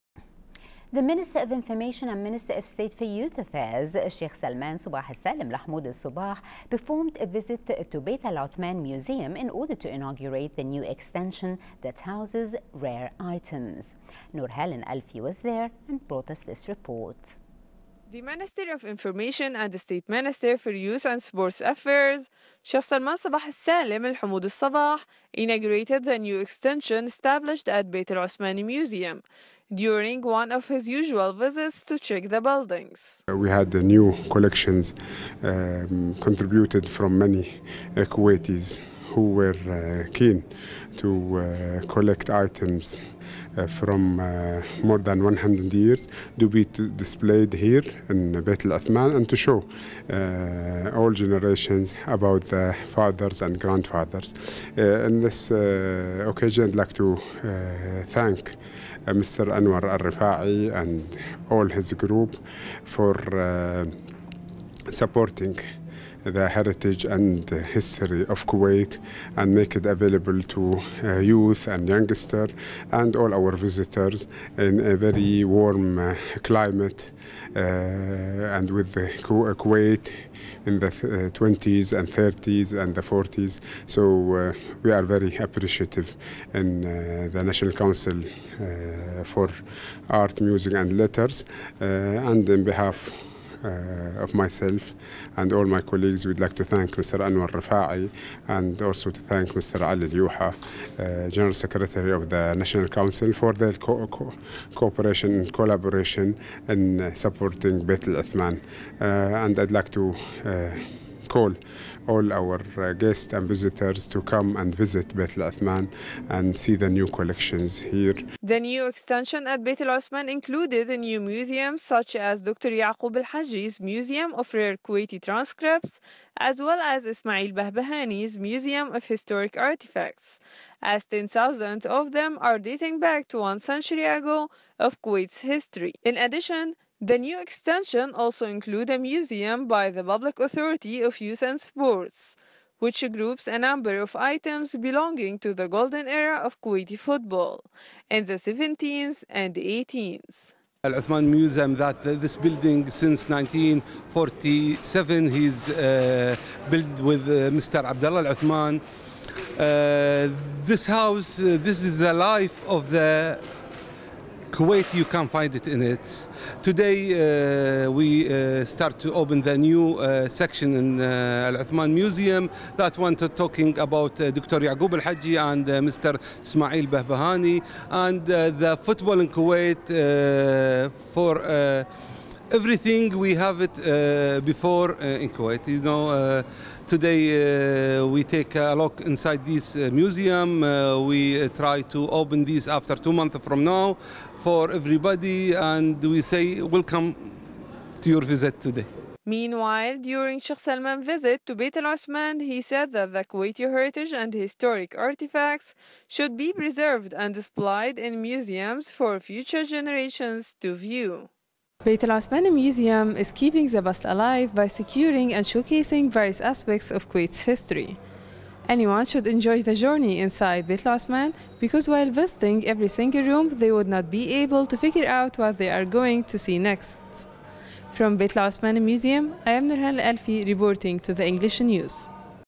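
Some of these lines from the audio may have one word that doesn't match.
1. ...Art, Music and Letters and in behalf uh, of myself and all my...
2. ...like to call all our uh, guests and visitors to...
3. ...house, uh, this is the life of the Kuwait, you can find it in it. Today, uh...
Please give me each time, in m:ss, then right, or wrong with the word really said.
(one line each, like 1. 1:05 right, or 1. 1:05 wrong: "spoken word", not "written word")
1. 1:30 right
2. 1:49 right
3. 2:40 right.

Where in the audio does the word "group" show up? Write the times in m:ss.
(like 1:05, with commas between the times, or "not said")
1:01, 2:23.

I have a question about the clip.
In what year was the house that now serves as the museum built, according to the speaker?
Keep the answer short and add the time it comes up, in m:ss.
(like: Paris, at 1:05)
1947, at 2:33.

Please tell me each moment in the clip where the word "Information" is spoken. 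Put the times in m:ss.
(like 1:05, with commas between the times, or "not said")
0:01, 0:18.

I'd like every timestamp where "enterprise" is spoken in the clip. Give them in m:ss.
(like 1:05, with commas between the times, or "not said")
not said.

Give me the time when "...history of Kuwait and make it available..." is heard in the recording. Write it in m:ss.
1:07.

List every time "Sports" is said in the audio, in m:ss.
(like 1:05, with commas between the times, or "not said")
0:21, 2:21.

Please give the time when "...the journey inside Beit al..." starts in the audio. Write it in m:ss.
3:39.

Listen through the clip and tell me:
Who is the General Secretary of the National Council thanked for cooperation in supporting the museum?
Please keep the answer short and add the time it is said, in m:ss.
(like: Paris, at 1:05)
Ali Al-Youha, at 1:39.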